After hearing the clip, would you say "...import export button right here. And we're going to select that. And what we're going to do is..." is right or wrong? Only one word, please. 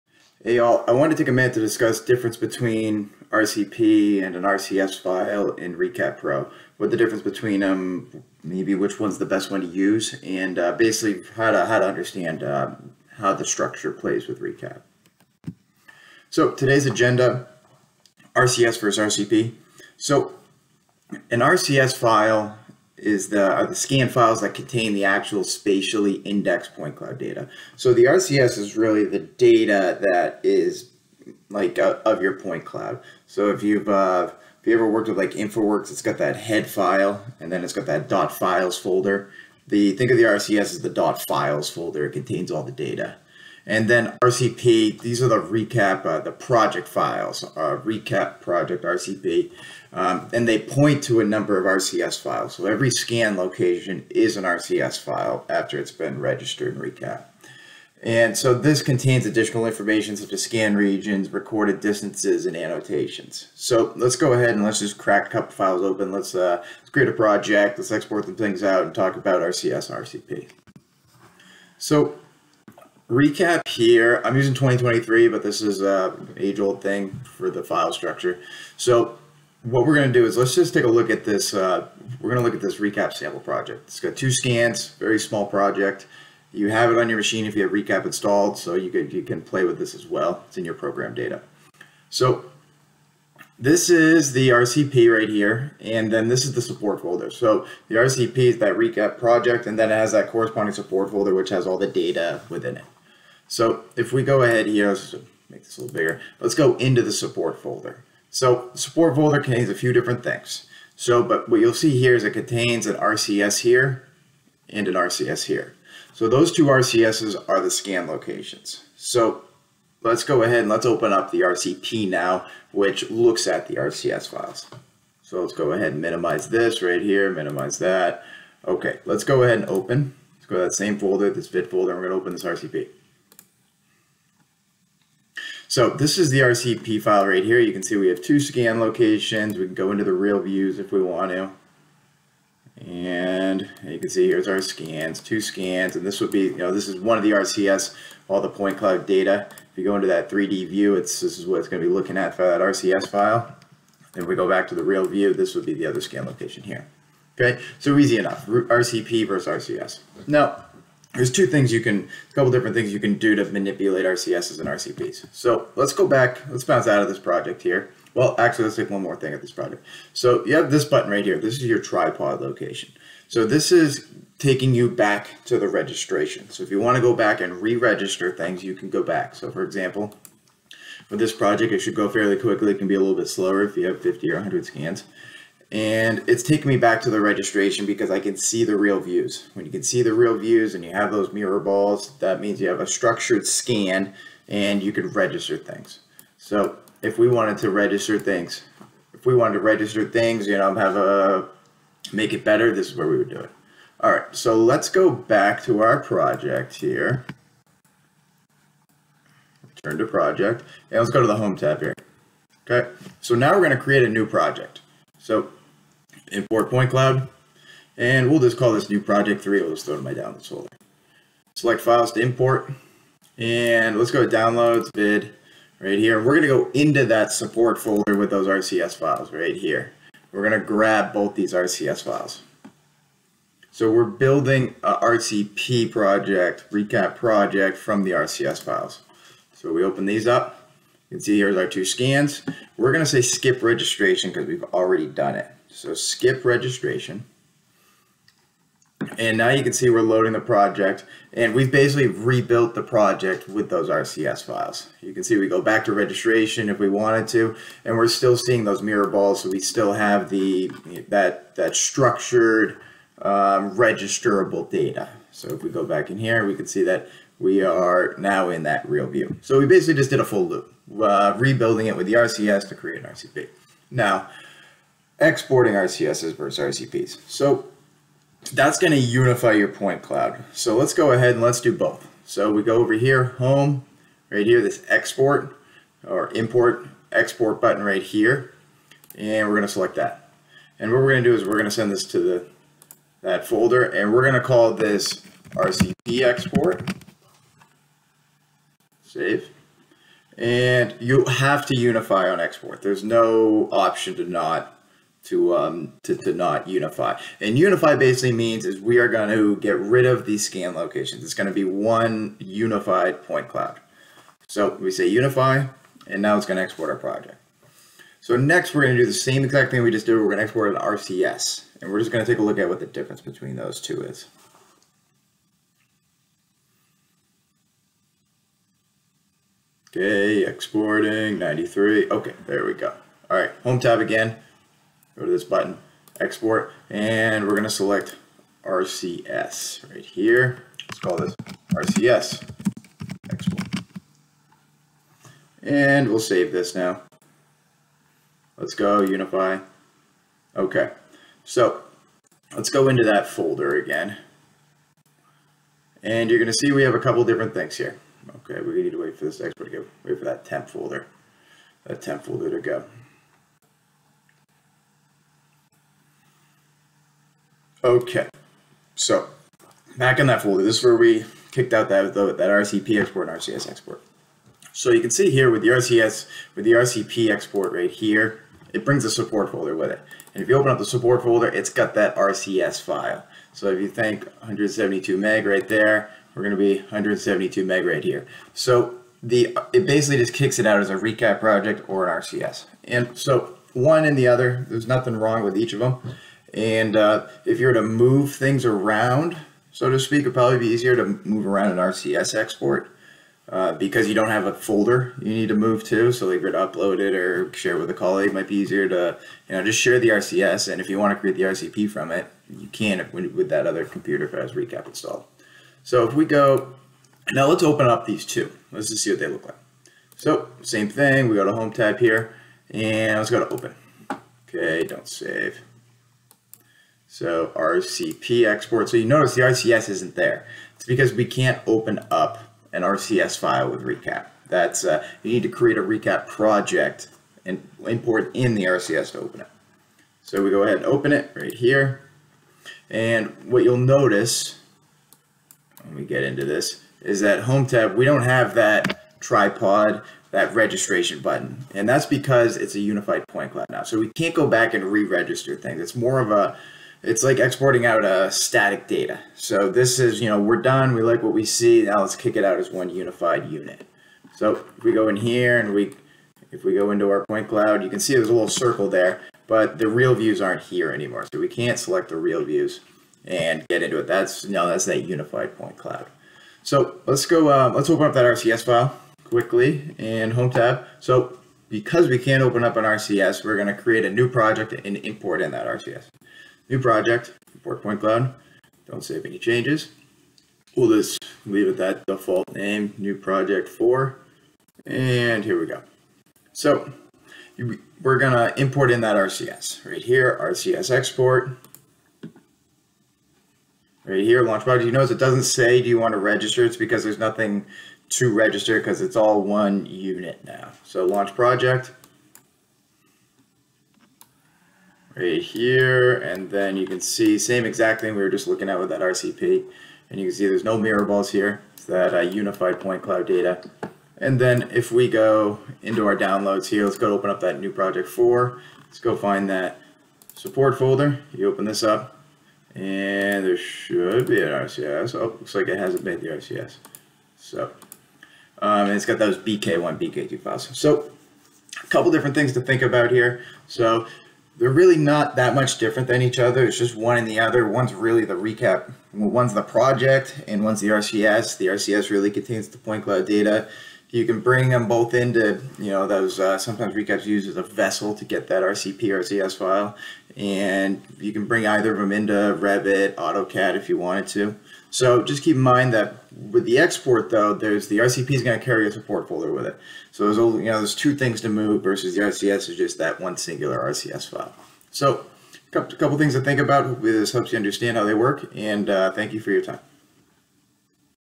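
right.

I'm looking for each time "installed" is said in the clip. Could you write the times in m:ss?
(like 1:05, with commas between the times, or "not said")
1:28, 6:54.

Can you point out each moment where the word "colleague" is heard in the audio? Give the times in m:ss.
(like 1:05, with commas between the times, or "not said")
6:47.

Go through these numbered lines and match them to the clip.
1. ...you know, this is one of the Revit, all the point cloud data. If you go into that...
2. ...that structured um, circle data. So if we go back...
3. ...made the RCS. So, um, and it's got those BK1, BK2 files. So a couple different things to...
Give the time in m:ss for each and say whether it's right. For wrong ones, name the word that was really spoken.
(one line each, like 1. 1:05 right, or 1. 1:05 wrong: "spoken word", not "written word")
1. 2:26 wrong: "RCS", not "Revit"
2. 4:21 wrong: "registerable", not "circle"
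3. 8:56 right.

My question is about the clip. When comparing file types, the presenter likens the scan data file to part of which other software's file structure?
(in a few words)
InfoWorks.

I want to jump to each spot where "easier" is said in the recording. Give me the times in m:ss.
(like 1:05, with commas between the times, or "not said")
6:40, 6:48.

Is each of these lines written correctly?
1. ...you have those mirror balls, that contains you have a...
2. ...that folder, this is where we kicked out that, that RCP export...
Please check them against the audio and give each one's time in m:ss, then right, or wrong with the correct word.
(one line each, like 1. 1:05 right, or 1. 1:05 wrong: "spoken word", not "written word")
1. 3:10 wrong: "means", not "contains"
2. 6:10 right.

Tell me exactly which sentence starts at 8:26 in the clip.
It's because there's nothing to register because it's all one unit now.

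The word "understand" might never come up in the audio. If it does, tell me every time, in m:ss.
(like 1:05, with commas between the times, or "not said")
0:11, 9:37.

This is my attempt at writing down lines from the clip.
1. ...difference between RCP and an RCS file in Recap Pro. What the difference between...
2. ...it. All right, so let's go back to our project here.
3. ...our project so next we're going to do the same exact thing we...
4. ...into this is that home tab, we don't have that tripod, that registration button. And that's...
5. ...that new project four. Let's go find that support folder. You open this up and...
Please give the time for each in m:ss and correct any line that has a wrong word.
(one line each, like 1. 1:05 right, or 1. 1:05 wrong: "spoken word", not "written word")
1. 0:02 right
2. 3:23 right
3. 5:16 right
4. 7:26 right
5. 8:47 right.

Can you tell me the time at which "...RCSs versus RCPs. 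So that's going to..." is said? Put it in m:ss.
4:35.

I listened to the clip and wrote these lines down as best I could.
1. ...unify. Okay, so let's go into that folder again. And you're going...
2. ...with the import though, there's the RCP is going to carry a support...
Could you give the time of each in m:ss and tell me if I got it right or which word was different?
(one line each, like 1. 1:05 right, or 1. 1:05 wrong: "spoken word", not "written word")
1. 5:49 right
2. 9:26 wrong: "export", not "import".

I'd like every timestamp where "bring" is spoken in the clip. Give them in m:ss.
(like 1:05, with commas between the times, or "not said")
6:18, 9:14, 9:21.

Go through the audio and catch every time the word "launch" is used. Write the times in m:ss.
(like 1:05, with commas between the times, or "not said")
8:24, 8:31.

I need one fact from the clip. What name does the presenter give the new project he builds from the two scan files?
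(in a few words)
new project three.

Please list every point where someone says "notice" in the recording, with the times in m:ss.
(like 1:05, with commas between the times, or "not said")
7:09, 7:23, 8:24.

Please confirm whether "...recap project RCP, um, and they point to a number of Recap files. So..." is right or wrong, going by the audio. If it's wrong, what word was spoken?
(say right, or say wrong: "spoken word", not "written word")
wrong: "RCS", not "Recap".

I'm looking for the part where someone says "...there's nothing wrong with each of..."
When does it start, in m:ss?
6:34.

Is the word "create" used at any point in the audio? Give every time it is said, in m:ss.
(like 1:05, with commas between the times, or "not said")
1:06, 3:33, 4:32, 6:51, 7:15, 8:03.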